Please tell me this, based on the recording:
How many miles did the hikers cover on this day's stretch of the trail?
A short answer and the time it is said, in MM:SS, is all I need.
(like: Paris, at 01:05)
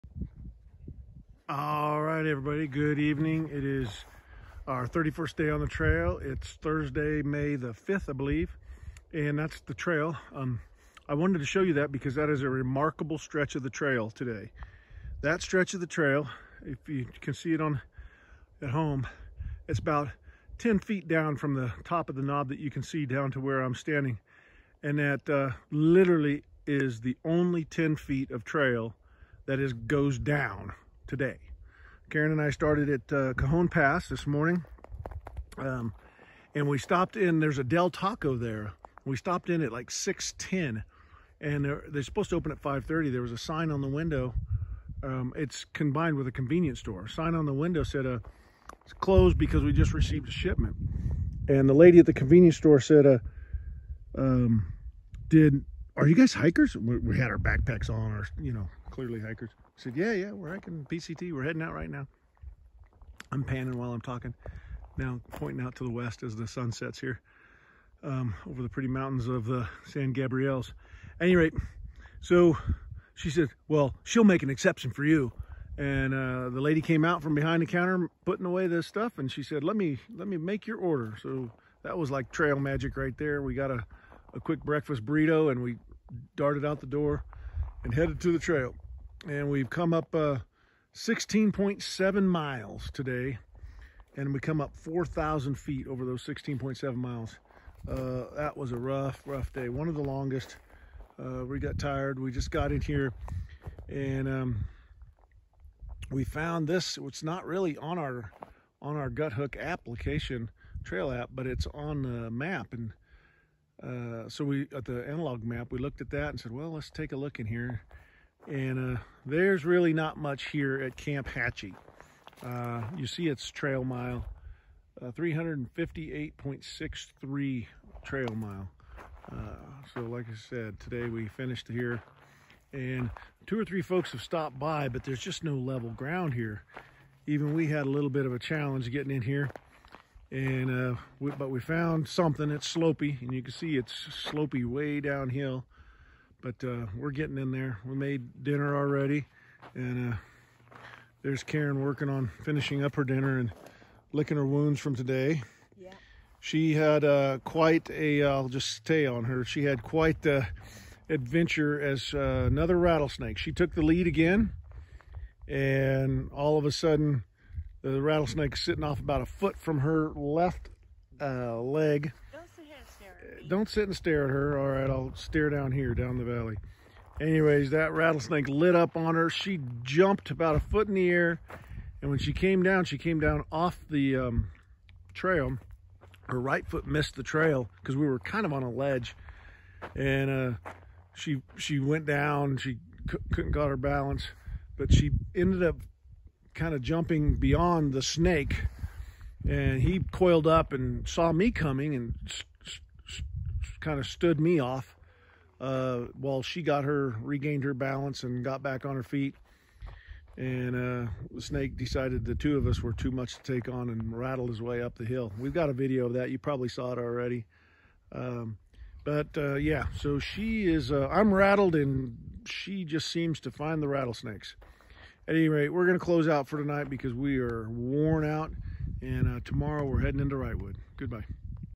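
16.7, at 01:30.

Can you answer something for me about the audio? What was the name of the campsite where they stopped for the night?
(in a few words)
Camp Hatchie.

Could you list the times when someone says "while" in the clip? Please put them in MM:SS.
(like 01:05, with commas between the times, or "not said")
01:03, 03:26.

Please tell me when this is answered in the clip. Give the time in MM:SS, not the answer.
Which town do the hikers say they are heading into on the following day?
03:50.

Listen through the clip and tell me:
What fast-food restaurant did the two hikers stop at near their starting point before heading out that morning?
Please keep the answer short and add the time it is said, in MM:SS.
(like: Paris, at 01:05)
Del Taco, at 00:37.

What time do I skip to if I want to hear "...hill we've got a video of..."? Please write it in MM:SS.
03:35.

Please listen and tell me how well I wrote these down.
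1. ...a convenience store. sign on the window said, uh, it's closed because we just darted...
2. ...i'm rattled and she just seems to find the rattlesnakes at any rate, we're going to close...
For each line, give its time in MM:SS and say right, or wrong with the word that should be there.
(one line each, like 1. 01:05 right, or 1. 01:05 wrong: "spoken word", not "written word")
1. 00:46 wrong: "received", not "darted"
2. 03:41 right.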